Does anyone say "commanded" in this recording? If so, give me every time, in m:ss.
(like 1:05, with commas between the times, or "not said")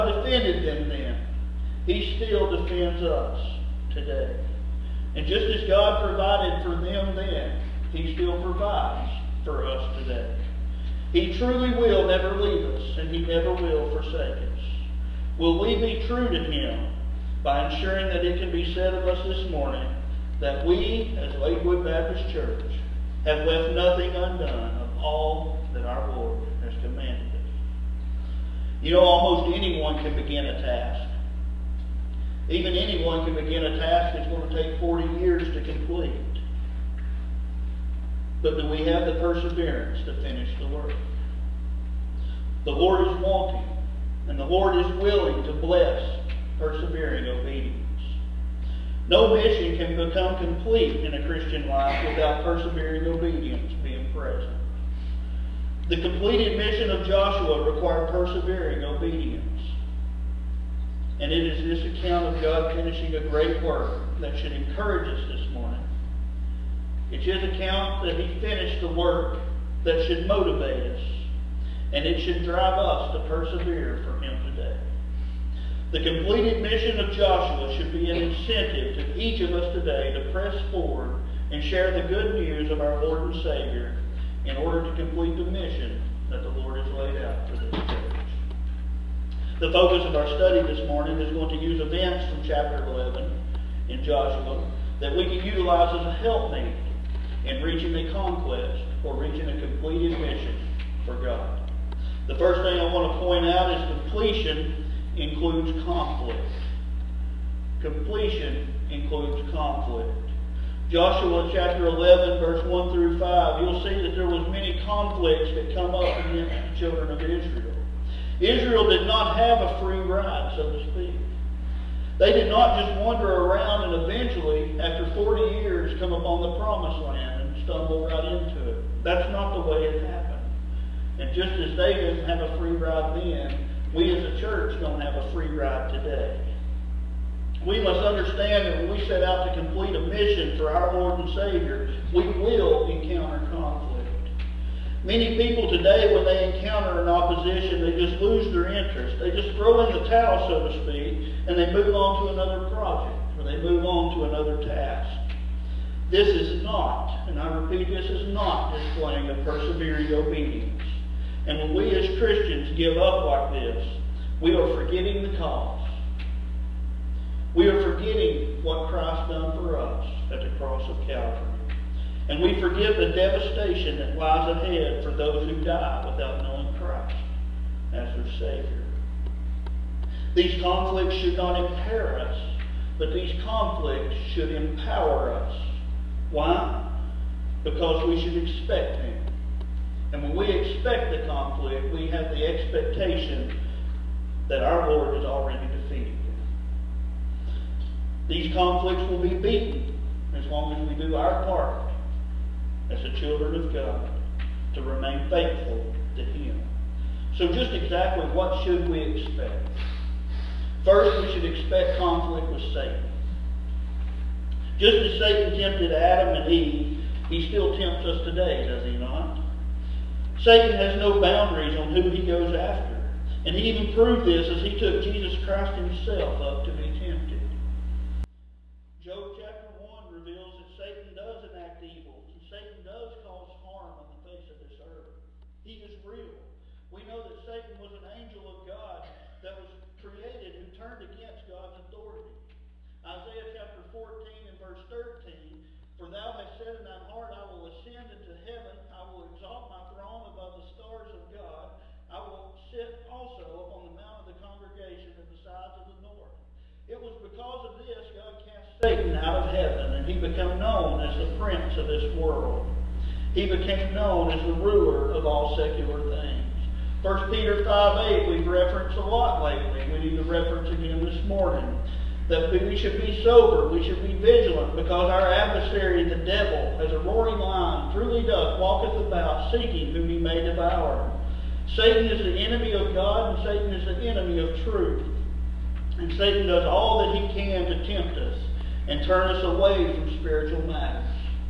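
0:26.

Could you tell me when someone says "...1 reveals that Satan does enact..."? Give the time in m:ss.
3:49.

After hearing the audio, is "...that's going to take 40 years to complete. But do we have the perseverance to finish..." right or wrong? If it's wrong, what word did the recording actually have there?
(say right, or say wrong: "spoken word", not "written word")
right.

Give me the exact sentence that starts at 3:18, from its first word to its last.
These conflicts will be beaten as long as we do our part as the children of God to remain faithful to Him.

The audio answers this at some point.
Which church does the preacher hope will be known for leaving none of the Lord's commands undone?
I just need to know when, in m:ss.
0:21.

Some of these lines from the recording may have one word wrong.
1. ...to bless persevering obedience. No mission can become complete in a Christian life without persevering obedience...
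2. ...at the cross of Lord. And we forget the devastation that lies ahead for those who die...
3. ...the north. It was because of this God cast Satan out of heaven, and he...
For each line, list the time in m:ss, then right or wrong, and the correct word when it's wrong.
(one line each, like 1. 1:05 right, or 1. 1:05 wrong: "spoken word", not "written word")
1. 0:45 right
2. 2:50 wrong: "Calvary", not "Lord"
3. 4:15 right.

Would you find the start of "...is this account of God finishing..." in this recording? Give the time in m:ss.
1:01.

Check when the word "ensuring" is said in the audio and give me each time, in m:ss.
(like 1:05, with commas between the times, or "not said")
0:17.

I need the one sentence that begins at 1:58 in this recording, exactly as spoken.
Israel did not have a free ride, so to speak.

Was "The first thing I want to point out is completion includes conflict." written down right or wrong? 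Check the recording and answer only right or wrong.
right.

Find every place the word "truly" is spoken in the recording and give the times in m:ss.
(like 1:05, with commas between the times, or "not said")
0:11, 4:37.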